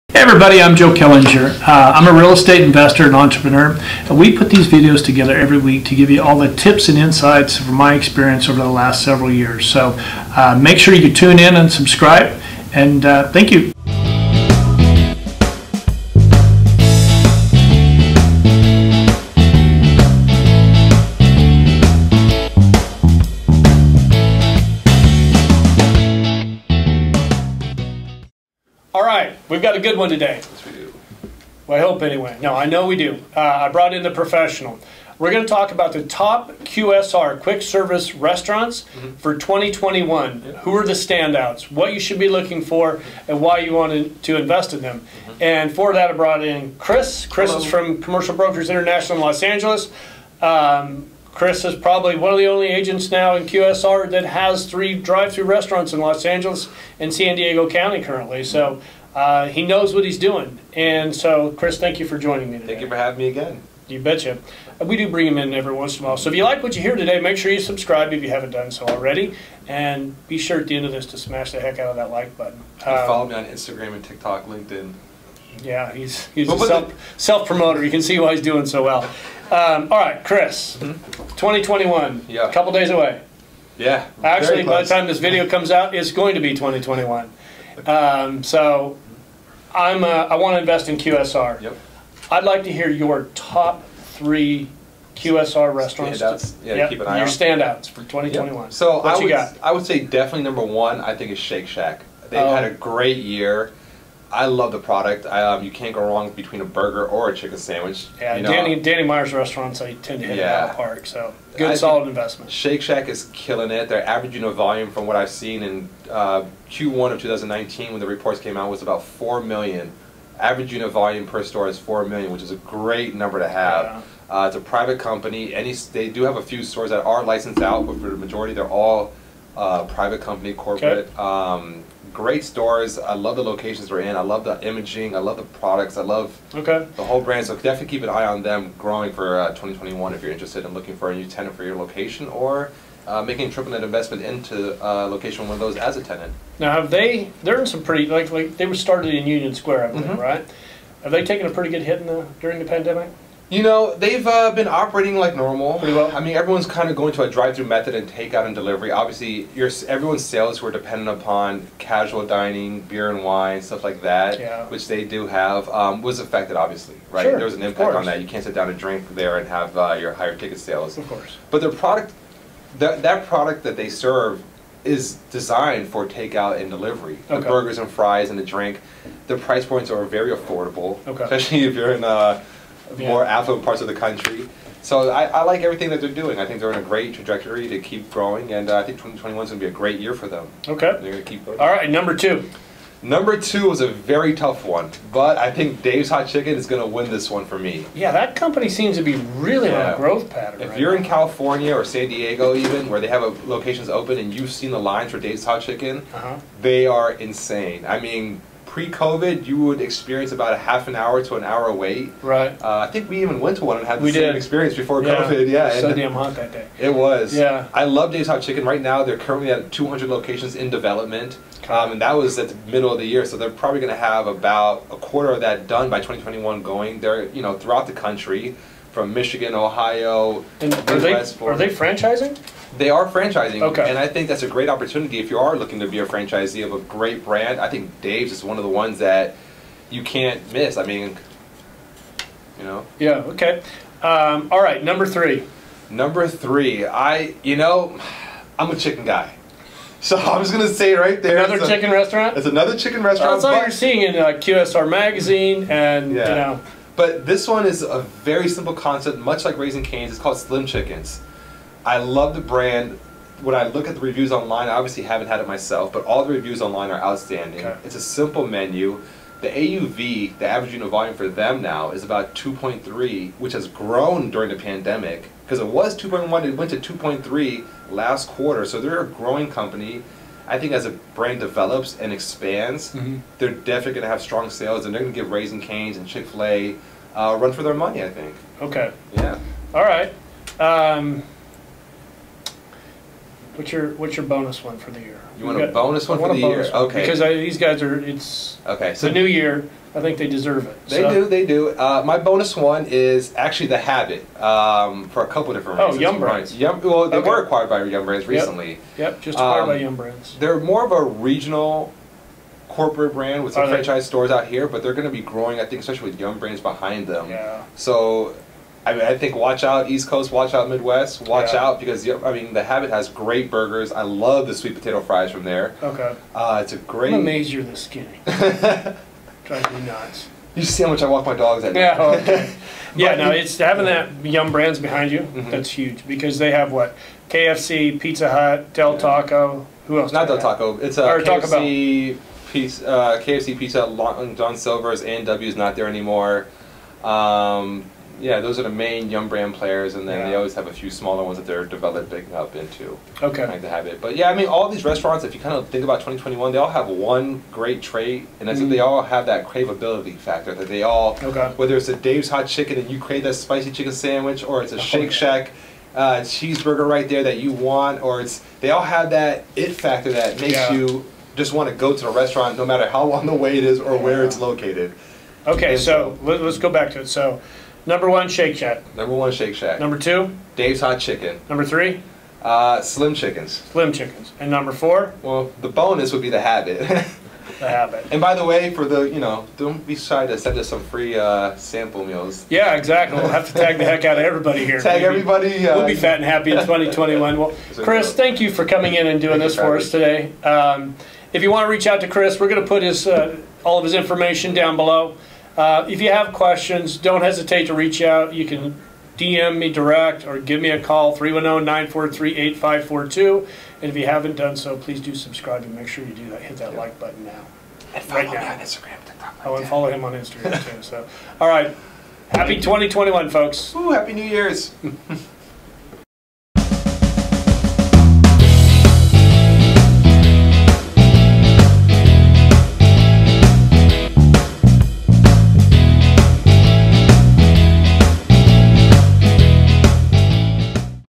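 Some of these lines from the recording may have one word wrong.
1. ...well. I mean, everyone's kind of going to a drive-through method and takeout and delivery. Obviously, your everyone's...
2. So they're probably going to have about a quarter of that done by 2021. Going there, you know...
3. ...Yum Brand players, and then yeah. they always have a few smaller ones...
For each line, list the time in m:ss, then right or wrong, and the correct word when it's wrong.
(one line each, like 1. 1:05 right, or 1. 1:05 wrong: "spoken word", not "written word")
1. 2:35 right
2. 3:43 right
3. 5:49 right.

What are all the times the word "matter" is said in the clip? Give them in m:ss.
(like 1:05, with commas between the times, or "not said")
6:12.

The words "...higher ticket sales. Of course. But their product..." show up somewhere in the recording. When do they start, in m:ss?
2:50.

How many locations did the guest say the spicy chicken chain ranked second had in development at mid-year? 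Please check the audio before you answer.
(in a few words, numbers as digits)
200.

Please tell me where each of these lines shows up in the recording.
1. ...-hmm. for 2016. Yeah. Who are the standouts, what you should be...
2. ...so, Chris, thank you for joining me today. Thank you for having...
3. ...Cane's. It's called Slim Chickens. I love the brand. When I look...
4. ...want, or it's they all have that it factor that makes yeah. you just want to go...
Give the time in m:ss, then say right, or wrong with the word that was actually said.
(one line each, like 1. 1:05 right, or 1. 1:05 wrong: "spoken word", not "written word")
1. 0:39 wrong: "2021", not "2016"
2. 1:01 right
3. 4:19 right
4. 6:07 right.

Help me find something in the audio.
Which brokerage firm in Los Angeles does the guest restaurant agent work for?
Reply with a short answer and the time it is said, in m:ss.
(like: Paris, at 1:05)
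Commercial Brokers International, at 0:48.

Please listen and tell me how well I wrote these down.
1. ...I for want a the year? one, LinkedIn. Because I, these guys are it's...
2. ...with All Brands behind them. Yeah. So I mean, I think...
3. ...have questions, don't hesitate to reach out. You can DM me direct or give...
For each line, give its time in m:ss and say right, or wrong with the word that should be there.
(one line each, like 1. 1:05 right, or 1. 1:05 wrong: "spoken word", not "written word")
1. 4:56 wrong: "Okay", not "LinkedIn"
2. 5:16 wrong: "Yum", not "All"
3. 6:46 right.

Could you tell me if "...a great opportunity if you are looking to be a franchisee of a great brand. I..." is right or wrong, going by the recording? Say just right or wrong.
right.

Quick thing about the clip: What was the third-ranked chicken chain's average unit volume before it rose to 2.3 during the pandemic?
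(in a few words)
2.1.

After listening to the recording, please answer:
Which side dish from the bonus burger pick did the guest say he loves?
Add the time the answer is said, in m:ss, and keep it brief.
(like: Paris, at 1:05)
sweet potato fries, at 5:24.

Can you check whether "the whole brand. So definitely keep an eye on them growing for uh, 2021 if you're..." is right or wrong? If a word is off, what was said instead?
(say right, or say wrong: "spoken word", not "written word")
right.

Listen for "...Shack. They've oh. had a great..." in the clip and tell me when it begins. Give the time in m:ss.
1:41.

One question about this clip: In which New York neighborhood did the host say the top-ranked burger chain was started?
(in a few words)
Union Square.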